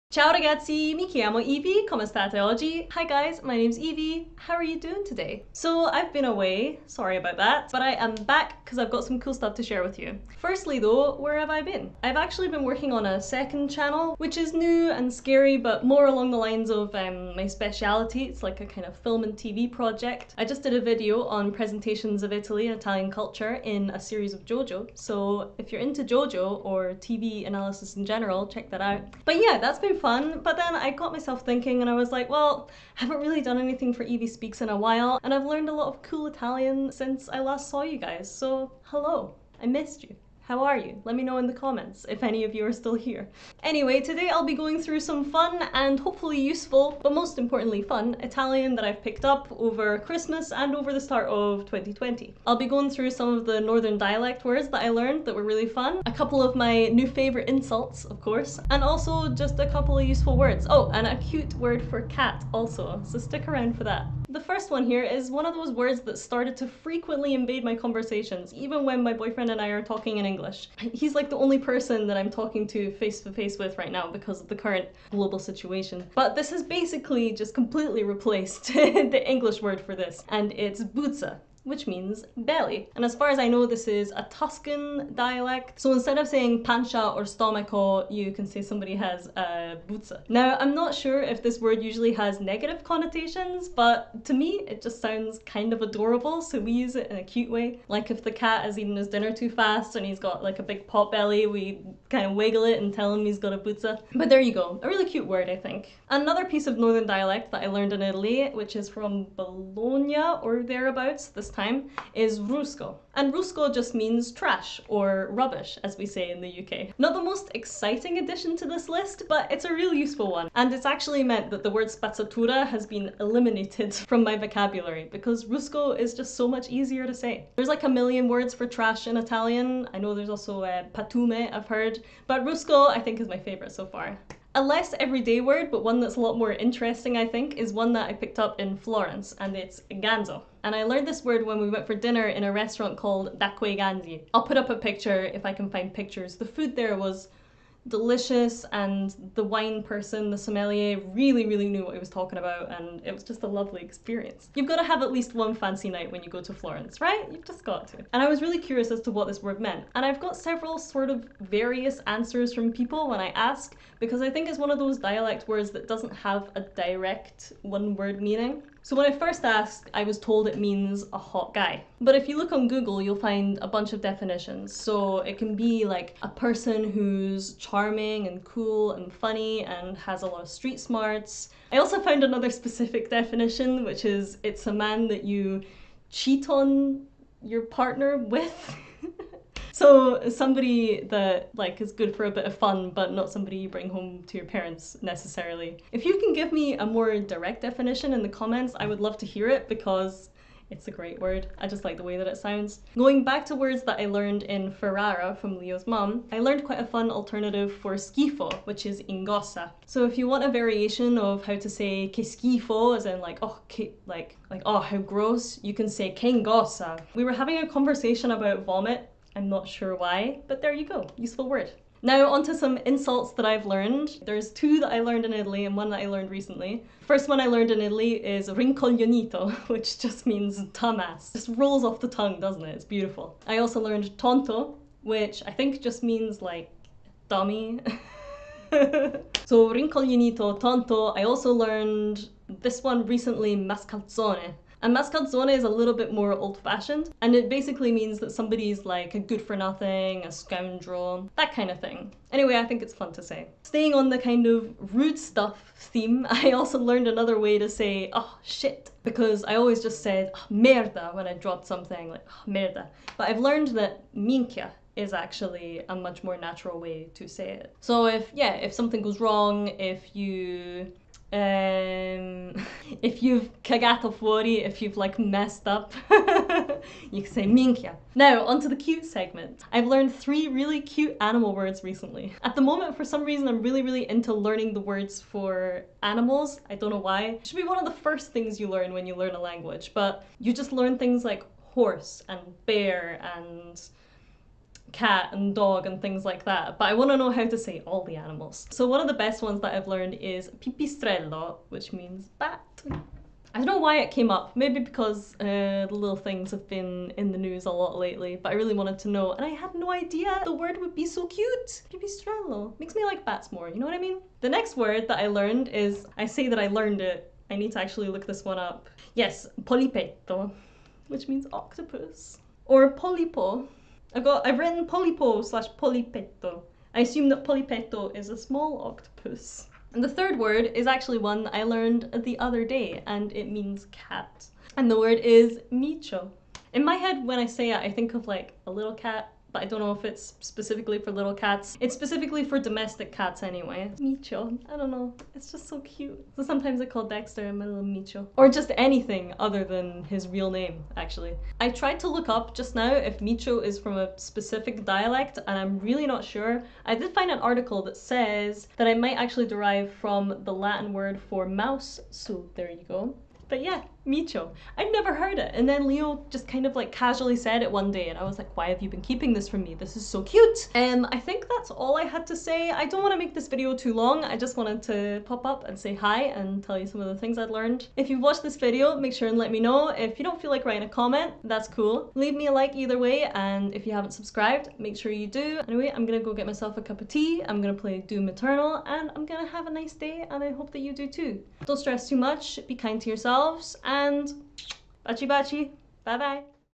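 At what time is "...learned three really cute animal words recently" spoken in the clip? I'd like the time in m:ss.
4:39.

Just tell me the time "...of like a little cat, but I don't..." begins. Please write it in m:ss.
5:38.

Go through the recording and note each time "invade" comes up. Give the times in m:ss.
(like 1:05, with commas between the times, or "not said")
1:07.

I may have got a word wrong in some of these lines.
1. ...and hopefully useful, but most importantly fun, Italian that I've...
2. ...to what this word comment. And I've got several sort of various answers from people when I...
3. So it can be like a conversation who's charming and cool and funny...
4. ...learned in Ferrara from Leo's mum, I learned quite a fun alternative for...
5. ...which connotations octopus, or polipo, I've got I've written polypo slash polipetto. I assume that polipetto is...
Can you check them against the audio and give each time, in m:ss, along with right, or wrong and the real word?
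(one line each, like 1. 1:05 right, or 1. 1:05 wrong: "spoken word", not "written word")
1. 0:45 right
2. 2:39 wrong: "meant", not "comment"
3. 2:54 wrong: "person", not "conversation"
4. 3:24 right
5. 5:21 wrong: "means", not "connotations".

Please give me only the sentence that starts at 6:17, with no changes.
If you've watched this video, make sure and let me know.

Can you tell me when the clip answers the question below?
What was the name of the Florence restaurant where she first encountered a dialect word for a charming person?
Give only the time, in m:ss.
2:23.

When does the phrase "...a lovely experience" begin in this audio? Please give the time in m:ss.
2:33.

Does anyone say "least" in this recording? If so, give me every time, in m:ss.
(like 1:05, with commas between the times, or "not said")
2:35.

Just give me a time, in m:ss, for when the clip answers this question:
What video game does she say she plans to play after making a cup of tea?
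6:27.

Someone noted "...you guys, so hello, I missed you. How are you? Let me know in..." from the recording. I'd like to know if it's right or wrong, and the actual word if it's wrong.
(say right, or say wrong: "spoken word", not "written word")
right.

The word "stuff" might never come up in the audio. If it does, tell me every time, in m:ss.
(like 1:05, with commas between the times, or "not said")
0:09, 4:15.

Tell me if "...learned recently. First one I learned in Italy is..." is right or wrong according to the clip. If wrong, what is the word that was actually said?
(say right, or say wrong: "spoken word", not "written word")
right.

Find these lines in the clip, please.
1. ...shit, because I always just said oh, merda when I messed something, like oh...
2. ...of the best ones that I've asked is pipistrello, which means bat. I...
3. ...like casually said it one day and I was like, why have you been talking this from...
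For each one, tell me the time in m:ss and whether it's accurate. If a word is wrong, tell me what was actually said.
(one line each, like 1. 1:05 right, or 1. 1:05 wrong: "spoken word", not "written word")
1. 4:18 wrong: "dropped", not "messed"
2. 4:58 wrong: "learned", not "asked"
3. 6:06 wrong: "keeping", not "talking".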